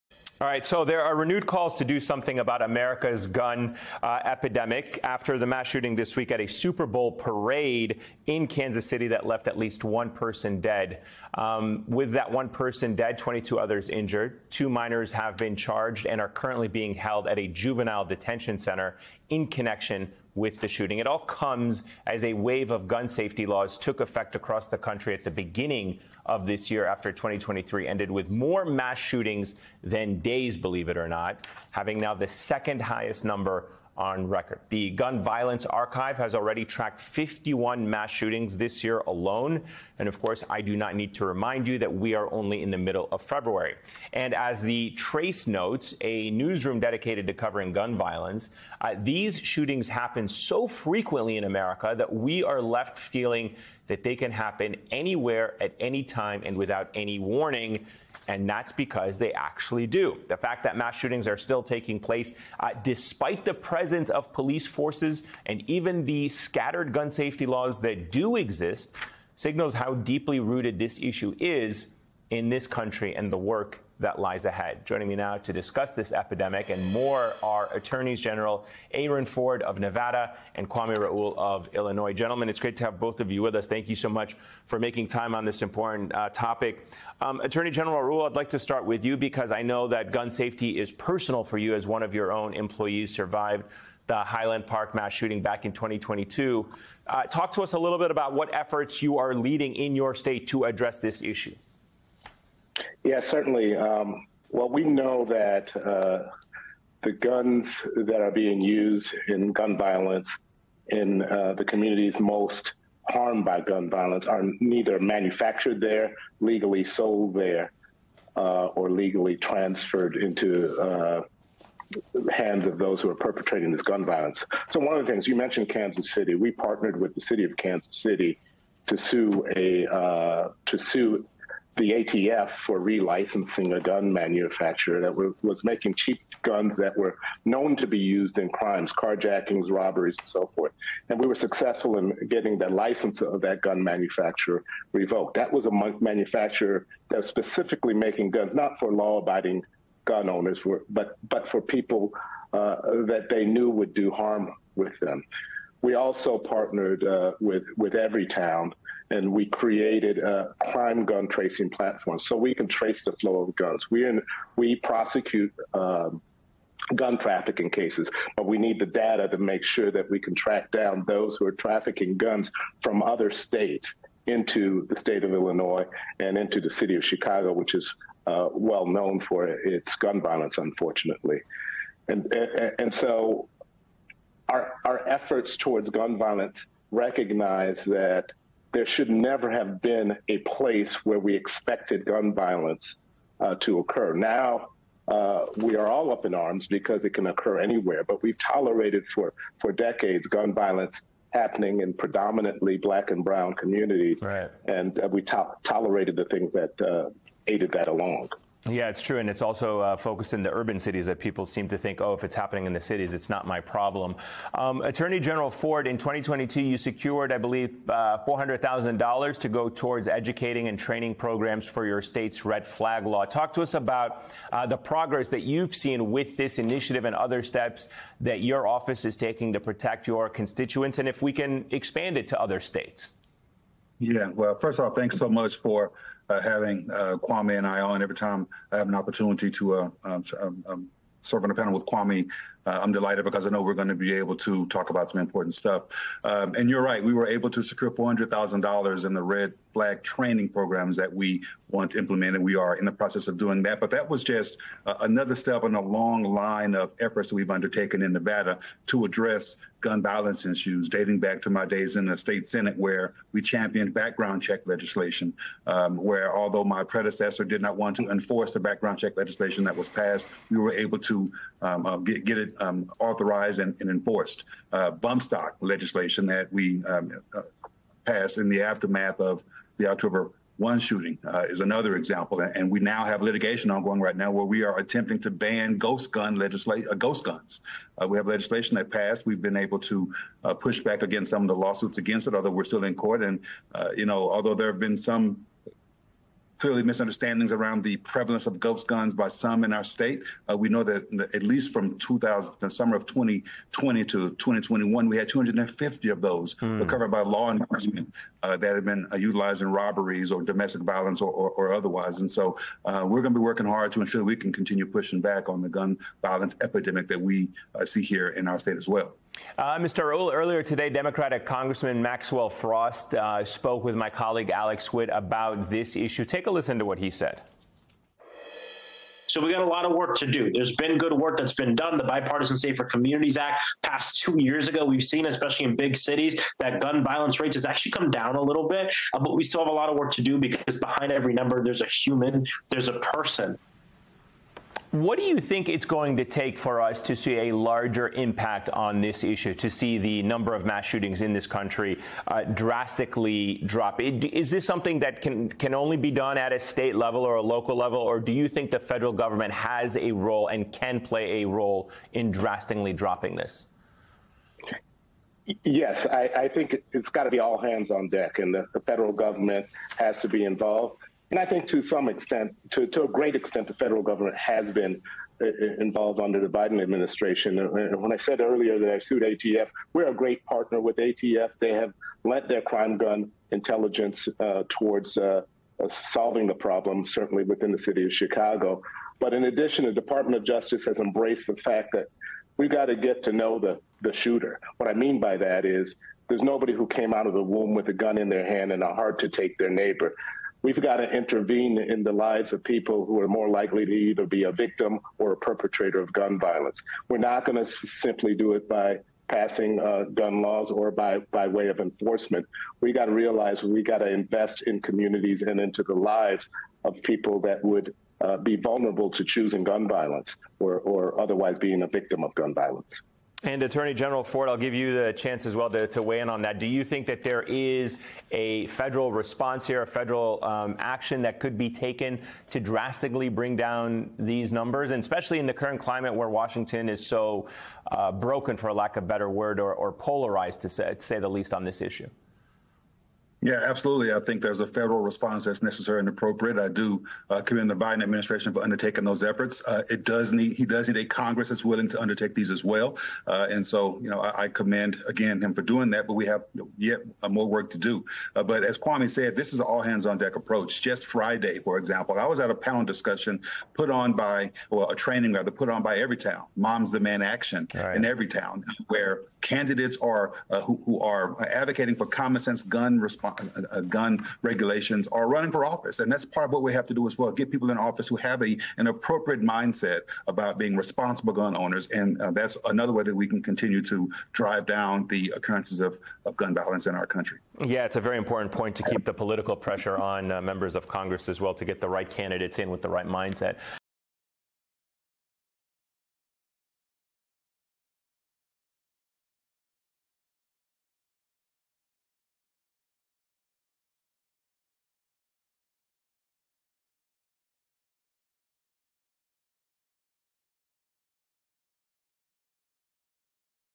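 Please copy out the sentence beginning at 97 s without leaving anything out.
Uh, talk to us a little bit about what efforts you are leading in your state to address this issue.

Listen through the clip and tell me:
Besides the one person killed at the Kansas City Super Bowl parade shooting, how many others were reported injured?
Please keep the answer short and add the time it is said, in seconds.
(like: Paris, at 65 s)
22, at 13 s.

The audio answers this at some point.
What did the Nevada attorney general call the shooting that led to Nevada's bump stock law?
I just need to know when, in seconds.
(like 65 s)
279 s.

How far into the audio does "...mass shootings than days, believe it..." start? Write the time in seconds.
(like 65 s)
28 s.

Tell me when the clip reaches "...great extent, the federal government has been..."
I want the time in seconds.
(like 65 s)
373 s.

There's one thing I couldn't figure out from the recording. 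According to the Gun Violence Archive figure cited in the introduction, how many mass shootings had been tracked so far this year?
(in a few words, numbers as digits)
51.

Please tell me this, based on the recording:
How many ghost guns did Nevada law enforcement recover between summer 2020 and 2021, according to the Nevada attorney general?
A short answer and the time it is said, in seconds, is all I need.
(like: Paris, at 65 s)
250, at 305 s.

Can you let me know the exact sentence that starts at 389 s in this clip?
But in addition, the Department of Justice has embraced the fact that we have got to get to know the, the shooter.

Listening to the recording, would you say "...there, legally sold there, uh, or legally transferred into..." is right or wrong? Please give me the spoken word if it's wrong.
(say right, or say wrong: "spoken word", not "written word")
right.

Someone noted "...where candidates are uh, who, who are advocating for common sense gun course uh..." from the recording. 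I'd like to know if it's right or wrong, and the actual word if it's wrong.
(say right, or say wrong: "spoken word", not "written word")
wrong: "response", not "course".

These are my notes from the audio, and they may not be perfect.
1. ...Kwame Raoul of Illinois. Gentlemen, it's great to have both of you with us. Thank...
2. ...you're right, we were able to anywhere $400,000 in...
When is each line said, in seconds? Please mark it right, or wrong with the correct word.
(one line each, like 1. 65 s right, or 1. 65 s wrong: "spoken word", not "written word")
1. 80 s right
2. 246 s wrong: "secure", not "anywhere".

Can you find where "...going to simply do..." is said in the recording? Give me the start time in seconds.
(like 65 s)
407 s.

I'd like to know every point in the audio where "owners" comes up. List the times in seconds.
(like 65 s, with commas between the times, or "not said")
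150 s, 481 s.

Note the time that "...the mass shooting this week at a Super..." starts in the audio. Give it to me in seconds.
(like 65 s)
5 s.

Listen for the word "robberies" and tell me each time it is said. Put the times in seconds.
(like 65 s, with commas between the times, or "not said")
139 s, 309 s.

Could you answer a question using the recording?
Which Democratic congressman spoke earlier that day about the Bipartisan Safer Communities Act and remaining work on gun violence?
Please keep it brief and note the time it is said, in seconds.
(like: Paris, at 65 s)
Maxwell Frost, at 322 s.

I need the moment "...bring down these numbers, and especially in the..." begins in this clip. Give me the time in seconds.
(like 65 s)
433 s.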